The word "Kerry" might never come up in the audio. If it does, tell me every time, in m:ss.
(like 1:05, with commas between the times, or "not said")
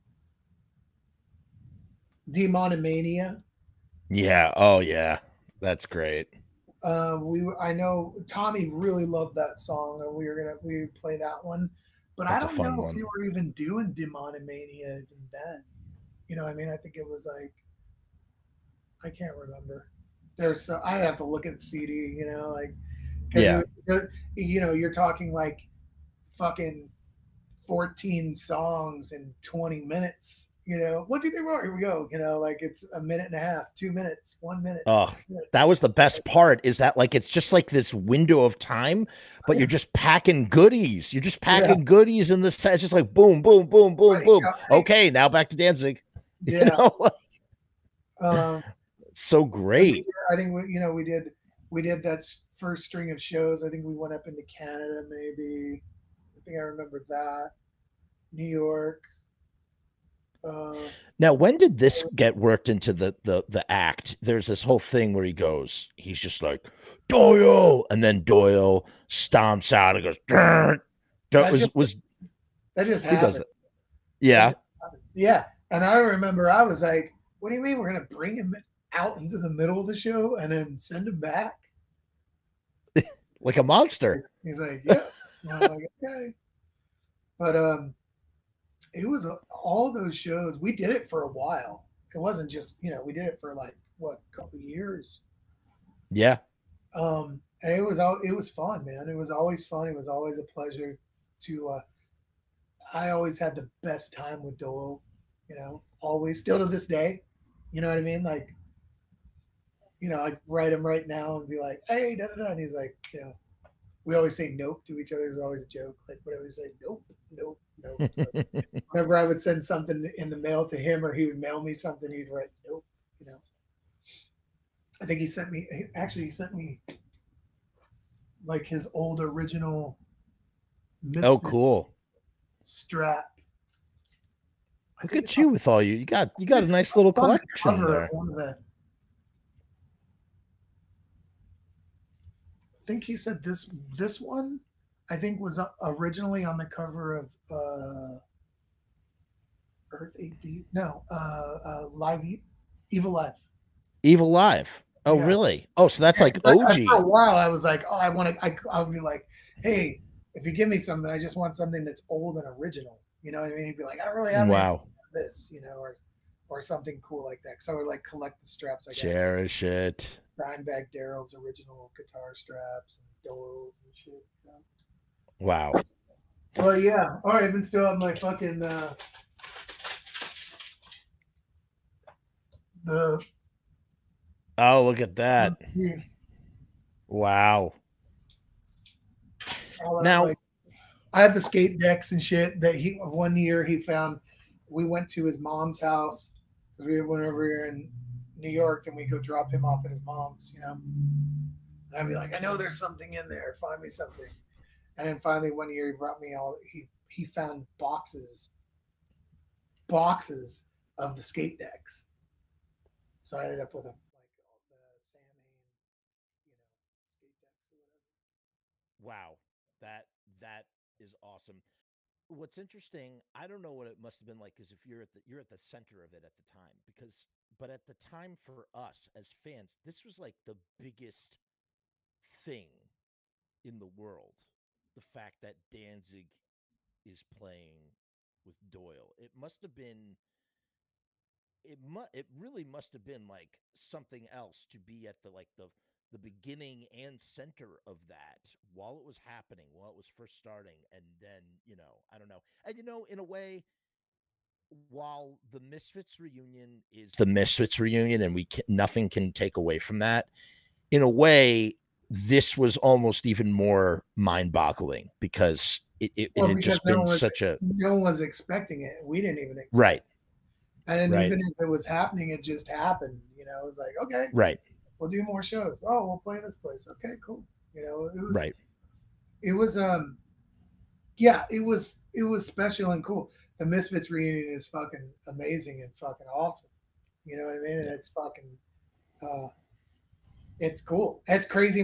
not said.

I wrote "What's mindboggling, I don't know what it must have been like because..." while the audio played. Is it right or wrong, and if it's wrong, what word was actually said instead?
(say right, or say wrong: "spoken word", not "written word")
wrong: "interesting", not "mindboggling".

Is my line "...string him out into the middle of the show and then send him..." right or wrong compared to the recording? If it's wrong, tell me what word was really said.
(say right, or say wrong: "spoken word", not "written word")
wrong: "bring", not "string".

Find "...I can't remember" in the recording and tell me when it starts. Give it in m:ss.
0:19.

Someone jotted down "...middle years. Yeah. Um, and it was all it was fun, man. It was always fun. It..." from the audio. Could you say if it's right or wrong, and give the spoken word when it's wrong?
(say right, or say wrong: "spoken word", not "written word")
wrong: "couple", not "middle".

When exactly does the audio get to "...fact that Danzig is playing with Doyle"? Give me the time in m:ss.
3:55.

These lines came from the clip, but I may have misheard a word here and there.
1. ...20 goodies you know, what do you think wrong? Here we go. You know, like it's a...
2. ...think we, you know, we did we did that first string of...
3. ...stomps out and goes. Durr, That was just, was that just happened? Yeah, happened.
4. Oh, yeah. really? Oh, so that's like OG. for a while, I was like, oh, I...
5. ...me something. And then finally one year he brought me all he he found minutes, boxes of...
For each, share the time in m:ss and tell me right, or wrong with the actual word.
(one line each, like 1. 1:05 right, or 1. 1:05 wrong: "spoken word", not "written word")
1. 0:29 wrong: "minutes", not "goodies"
2. 0:50 right
3. 1:09 right
4. 2:35 right
5. 3:23 wrong: "boxes", not "minutes".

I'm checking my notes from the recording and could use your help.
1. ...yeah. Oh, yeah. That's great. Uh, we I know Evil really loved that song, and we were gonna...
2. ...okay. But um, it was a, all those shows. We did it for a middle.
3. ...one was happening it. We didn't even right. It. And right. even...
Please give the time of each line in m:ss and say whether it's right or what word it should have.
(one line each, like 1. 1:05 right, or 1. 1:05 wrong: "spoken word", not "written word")
1. 0:04 wrong: "Tommy", not "Evil"
2. 1:26 wrong: "while", not "middle"
3. 4:27 wrong: "expecting", not "happening".